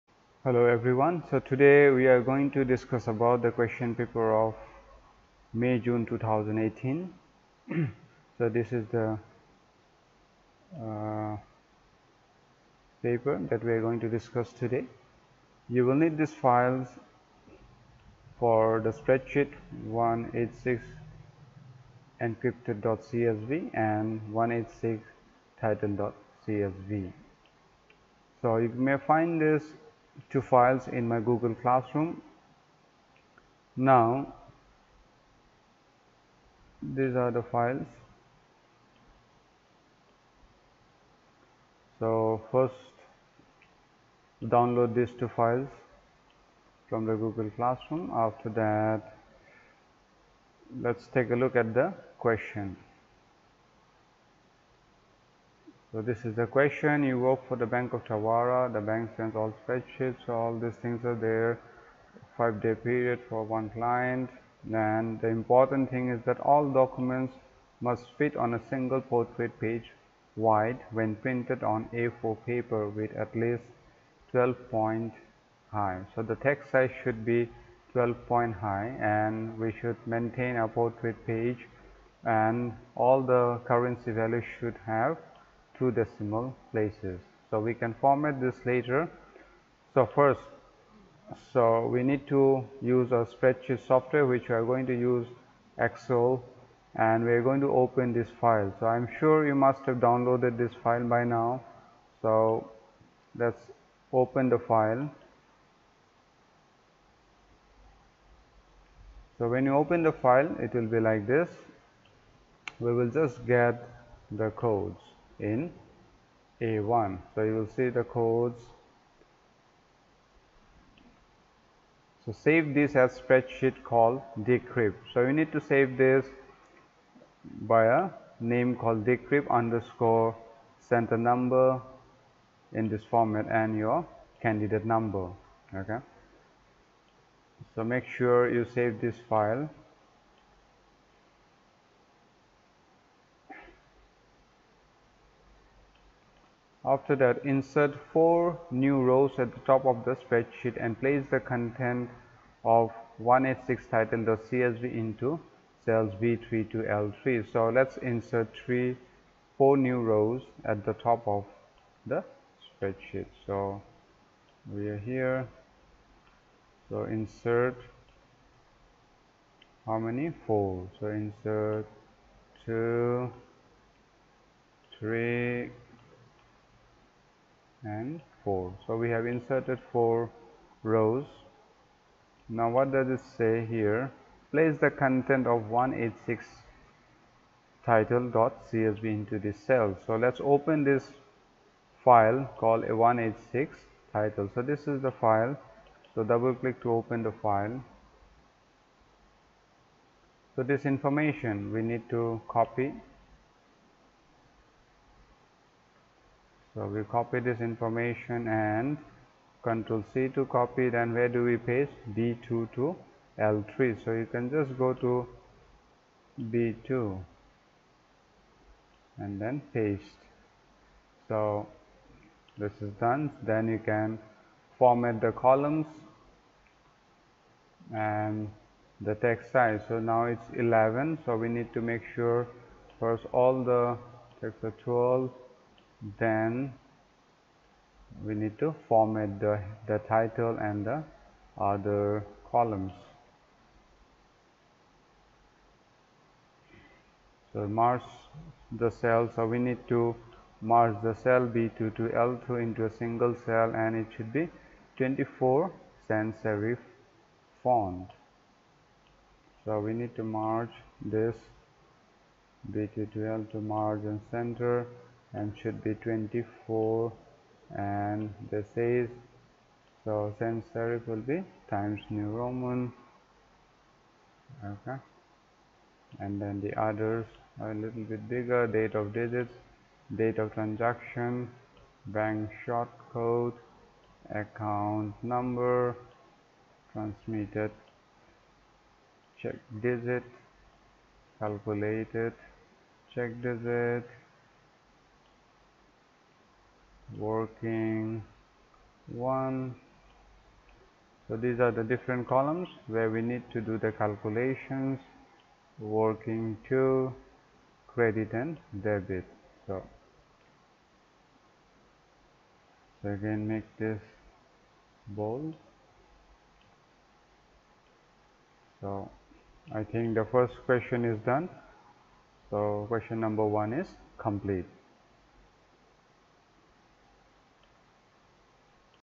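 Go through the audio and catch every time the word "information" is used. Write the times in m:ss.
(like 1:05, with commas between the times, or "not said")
3:20, 3:27.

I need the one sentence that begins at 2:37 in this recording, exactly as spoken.
So let's insert three, four new rows at the top of the spreadsheet.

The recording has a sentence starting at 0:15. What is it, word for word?
You will need these files for the spreadsheet 186 encrypted.csv and 186 title.csv.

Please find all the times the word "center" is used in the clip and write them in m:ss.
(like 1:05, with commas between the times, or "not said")
2:10, 4:24.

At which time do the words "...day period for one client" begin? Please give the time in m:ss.
1:02.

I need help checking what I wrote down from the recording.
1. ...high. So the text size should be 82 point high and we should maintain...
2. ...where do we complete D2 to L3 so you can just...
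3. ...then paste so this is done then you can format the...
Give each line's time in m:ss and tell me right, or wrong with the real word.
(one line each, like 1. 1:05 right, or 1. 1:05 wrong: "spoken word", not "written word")
1. 1:15 wrong: "12", not "82"
2. 3:31 wrong: "paste", not "complete"
3. 3:39 right.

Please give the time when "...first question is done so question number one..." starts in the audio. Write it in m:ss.
5:20.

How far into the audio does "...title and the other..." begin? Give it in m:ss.
4:00.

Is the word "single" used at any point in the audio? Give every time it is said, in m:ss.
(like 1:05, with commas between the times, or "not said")
1:08, 4:12.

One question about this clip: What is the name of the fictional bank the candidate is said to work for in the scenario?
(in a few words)
Bank of Tawara.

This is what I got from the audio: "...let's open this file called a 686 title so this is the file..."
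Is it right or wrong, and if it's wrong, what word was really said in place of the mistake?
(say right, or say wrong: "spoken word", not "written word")
wrong: "186", not "686".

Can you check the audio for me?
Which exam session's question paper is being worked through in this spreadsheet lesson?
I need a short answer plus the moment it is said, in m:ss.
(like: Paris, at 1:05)
May June 2018, at 0:05.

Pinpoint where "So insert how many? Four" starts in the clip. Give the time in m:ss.
2:46.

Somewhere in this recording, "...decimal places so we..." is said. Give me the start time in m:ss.
1:25.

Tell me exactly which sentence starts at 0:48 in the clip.
After that, let's take a look at the question.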